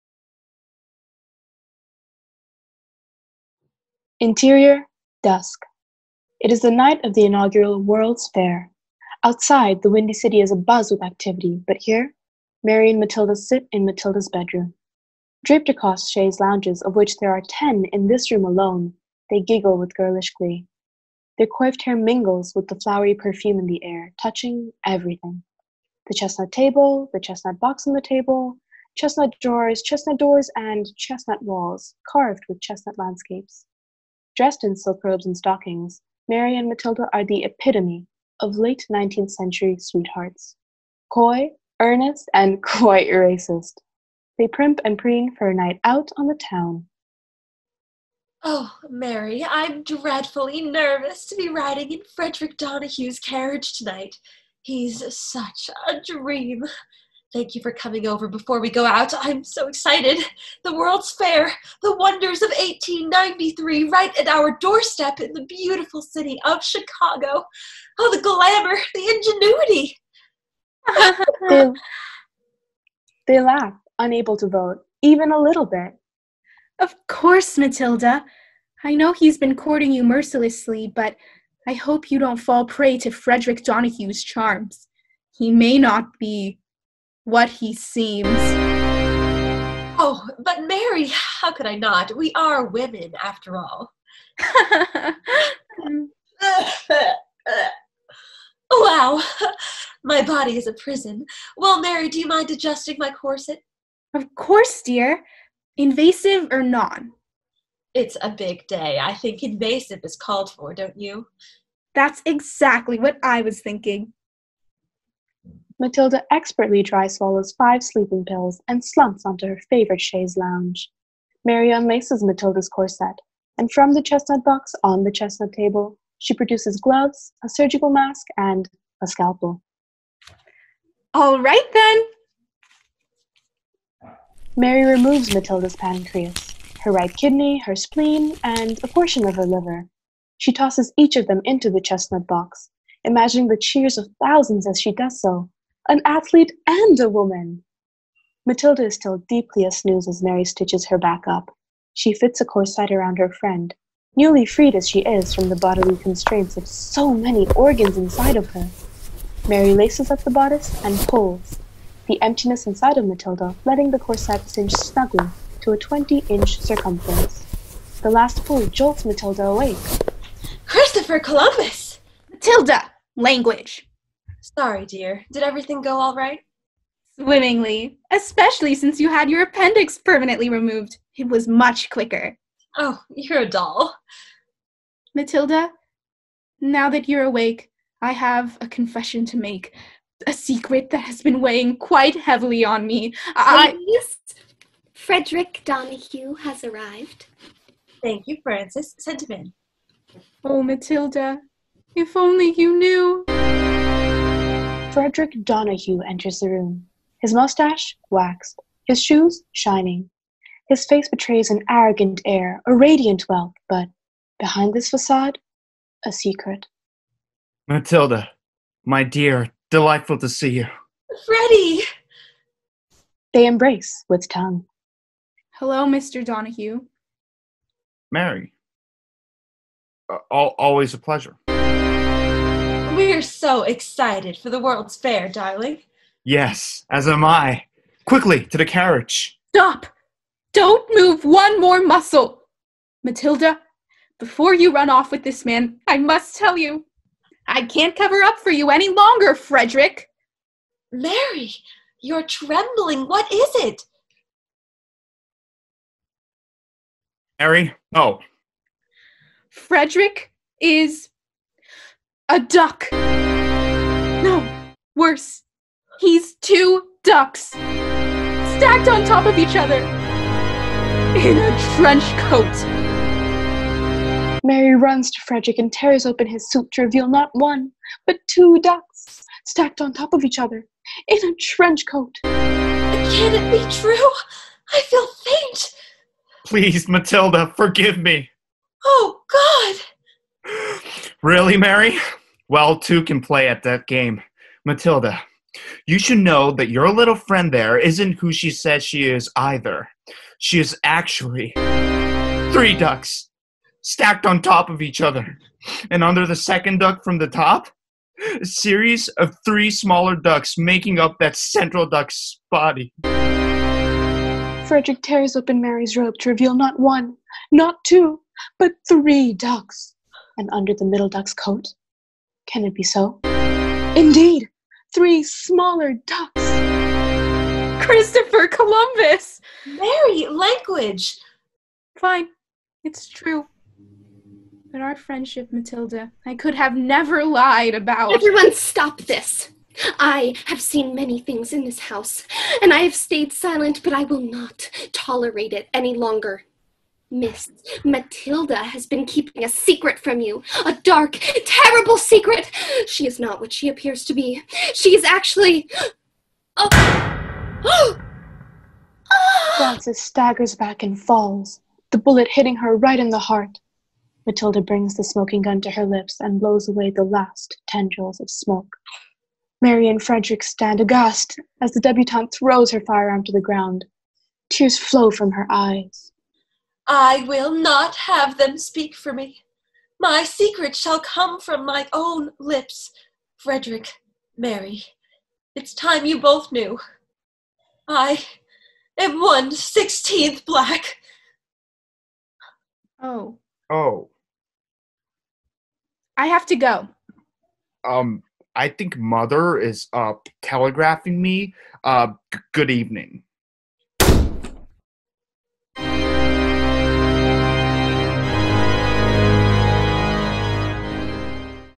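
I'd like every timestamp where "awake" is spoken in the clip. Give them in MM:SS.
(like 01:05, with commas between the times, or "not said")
02:49, 03:07.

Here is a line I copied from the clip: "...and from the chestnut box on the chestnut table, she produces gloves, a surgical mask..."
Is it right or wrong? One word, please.
right.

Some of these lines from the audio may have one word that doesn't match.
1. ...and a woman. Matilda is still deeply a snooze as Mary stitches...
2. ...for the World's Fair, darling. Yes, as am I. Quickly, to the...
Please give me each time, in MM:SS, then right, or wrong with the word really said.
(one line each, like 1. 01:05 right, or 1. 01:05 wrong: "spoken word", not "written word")
1. 02:26 right
2. 03:54 right.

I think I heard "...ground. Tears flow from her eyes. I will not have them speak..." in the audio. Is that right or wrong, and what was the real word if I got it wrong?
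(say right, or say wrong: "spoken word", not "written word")
right.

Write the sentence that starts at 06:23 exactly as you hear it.
Frederick, Mary, it's time you both knew.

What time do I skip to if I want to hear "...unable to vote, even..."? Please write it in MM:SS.
01:13.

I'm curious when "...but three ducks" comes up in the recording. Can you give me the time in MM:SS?
05:18.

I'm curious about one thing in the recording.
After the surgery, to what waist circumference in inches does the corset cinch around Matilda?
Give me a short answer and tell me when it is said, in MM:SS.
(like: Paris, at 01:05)
20, at 02:45.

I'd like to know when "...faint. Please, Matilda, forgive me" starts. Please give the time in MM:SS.
04:45.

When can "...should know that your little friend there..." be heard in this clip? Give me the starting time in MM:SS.
04:55.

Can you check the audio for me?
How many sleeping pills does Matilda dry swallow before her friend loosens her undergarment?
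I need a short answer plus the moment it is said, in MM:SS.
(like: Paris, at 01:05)
5, at 01:57.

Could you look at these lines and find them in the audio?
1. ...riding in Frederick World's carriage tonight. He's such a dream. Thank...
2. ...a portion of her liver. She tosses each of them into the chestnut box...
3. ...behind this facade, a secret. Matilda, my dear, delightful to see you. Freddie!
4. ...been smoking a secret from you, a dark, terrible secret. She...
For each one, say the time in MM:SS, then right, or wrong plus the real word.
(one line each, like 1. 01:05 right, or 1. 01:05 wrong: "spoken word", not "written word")
1. 00:51 wrong: "Donahue", not "World"
2. 02:18 right
3. 03:34 right
4. 05:48 wrong: "keeping", not "smoking".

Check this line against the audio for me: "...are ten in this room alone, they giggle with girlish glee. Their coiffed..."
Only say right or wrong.
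right.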